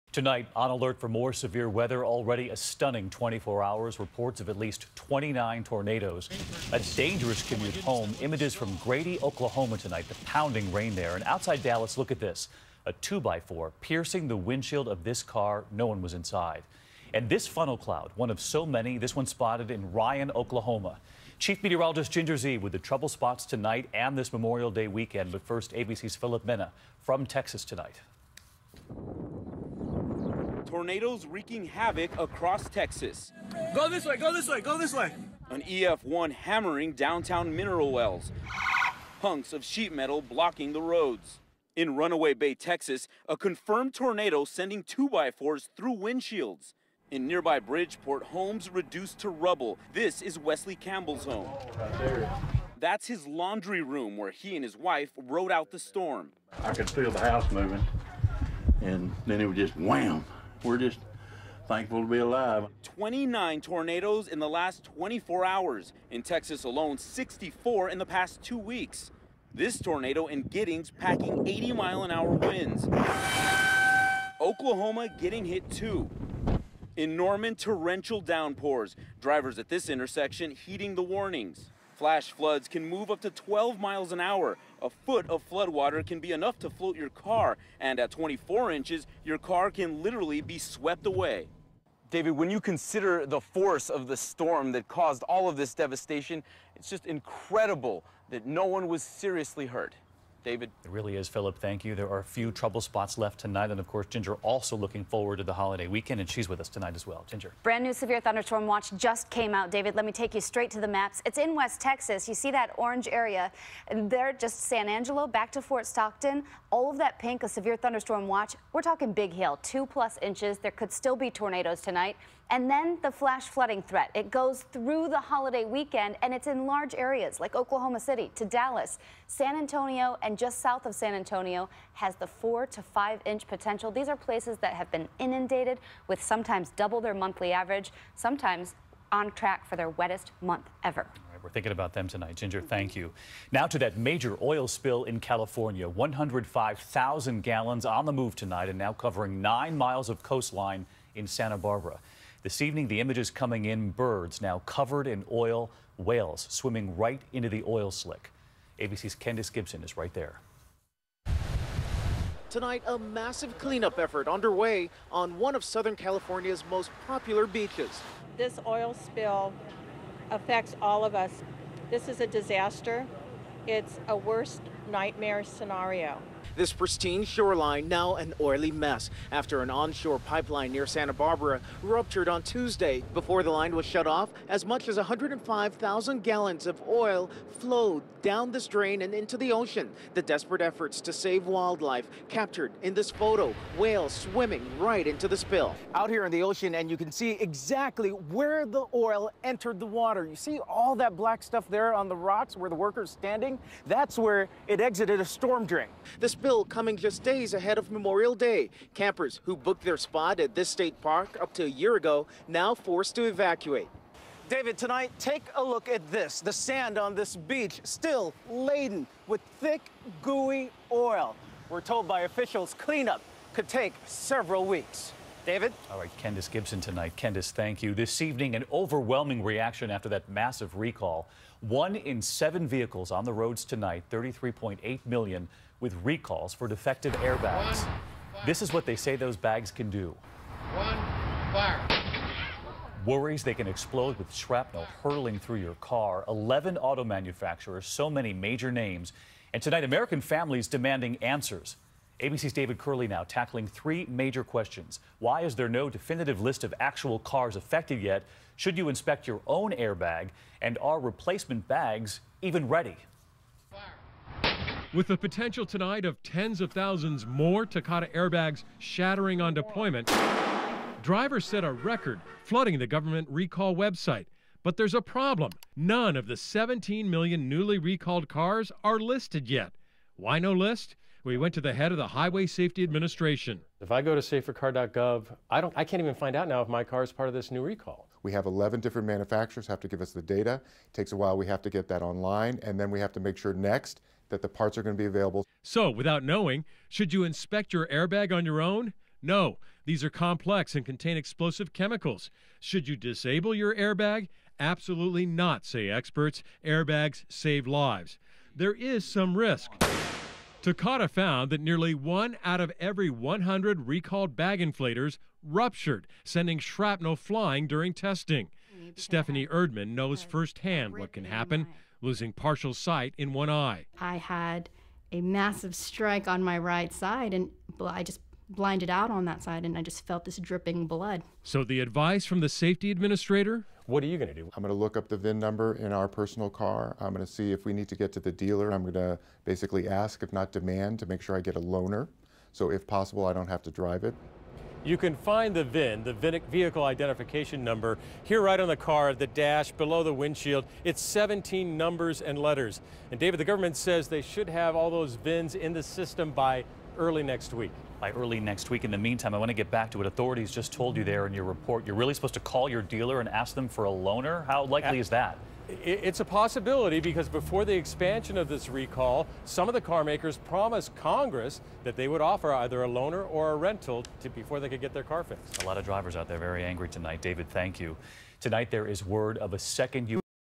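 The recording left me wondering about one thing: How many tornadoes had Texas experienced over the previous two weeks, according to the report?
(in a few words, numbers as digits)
64.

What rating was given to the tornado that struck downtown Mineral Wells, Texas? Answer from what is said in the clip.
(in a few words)
EF-1.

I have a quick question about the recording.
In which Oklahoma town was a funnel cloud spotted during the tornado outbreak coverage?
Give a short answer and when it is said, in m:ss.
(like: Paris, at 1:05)
Ryan, at 0:19.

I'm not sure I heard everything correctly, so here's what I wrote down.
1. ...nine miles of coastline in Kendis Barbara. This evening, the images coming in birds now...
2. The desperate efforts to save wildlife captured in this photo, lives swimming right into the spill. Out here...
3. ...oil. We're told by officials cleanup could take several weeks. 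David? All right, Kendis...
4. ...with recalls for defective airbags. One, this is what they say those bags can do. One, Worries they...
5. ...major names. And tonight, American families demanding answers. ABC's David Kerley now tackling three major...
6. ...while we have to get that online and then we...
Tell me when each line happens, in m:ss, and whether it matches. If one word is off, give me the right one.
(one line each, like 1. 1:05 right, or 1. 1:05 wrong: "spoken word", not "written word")
1. 2:29 wrong: "Santa", not "Kendis"
2. 3:10 wrong: "whales", not "lives"
3. 3:40 right
4. 3:55 right
5. 4:08 right
6. 4:51 right.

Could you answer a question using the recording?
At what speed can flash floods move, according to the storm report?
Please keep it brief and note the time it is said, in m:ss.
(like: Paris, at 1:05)
12 miles an hour, at 1:23.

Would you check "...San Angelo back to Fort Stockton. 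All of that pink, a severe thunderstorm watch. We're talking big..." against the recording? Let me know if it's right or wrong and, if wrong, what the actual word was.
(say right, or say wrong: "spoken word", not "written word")
right.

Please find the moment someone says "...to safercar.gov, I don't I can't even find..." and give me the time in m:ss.
4:44.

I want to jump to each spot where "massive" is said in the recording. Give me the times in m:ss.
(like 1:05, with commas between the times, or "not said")
2:42, 3:50, 5:25.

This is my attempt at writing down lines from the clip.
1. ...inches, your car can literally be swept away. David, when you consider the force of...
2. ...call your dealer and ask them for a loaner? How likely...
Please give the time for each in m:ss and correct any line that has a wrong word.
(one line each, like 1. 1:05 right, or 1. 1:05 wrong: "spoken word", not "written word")
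1. 1:28 right
2. 6:02 right.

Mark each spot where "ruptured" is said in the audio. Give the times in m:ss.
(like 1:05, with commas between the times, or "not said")
3:01, 5:15.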